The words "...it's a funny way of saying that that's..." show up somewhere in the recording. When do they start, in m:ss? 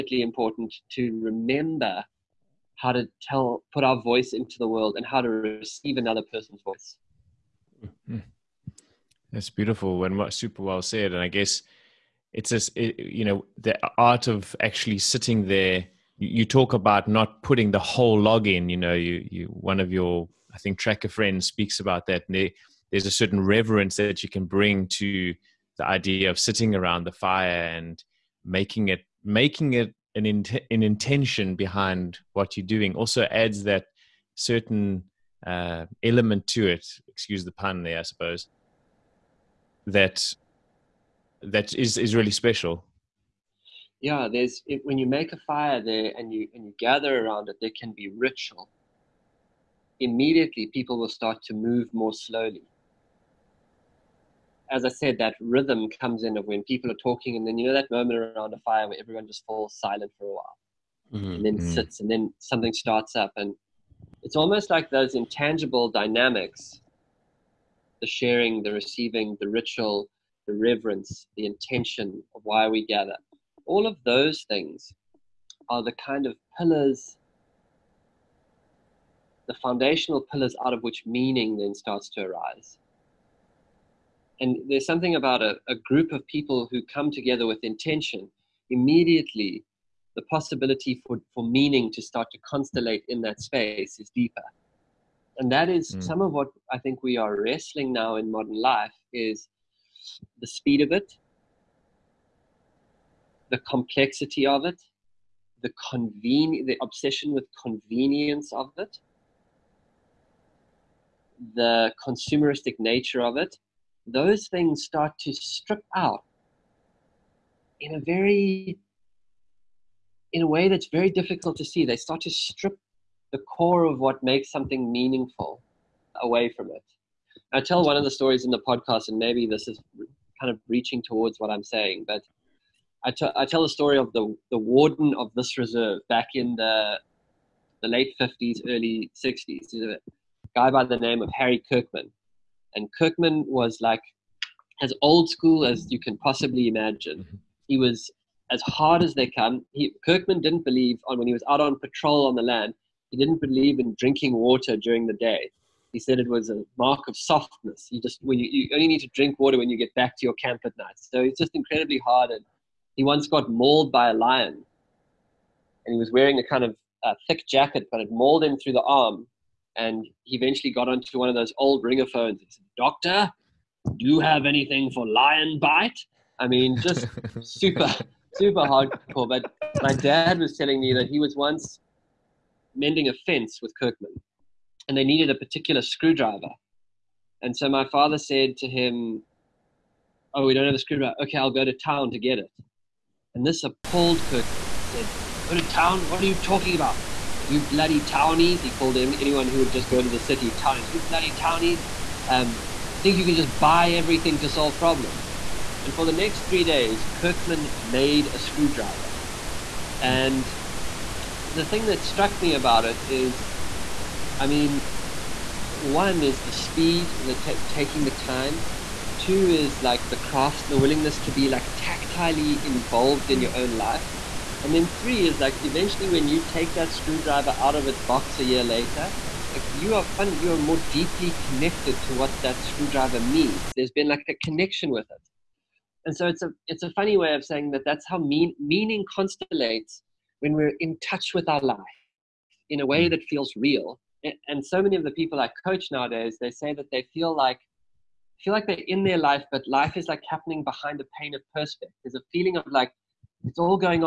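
3:56.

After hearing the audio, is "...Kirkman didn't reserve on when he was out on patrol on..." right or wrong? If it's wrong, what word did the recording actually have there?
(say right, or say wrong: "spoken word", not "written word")
wrong: "believe", not "reserve".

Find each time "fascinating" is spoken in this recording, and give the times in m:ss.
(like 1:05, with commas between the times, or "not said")
not said.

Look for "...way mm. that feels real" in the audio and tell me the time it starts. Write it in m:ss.
4:02.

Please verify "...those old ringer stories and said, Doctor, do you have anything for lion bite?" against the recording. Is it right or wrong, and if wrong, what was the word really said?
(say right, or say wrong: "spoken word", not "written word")
wrong: "phones", not "stories".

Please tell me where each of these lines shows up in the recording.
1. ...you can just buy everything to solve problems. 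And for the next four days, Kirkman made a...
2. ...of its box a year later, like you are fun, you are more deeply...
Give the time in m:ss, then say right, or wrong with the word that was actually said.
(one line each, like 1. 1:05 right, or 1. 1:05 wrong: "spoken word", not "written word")
1. 3:23 wrong: "three", not "four"
2. 3:47 right.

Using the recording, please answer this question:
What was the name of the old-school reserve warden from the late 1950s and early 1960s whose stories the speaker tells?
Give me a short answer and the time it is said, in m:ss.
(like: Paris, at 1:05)
Harry Kirkman, at 2:21.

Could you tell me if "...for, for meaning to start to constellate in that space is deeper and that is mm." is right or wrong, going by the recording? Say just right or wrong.
right.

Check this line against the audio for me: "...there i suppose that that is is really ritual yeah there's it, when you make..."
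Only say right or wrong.
wrong.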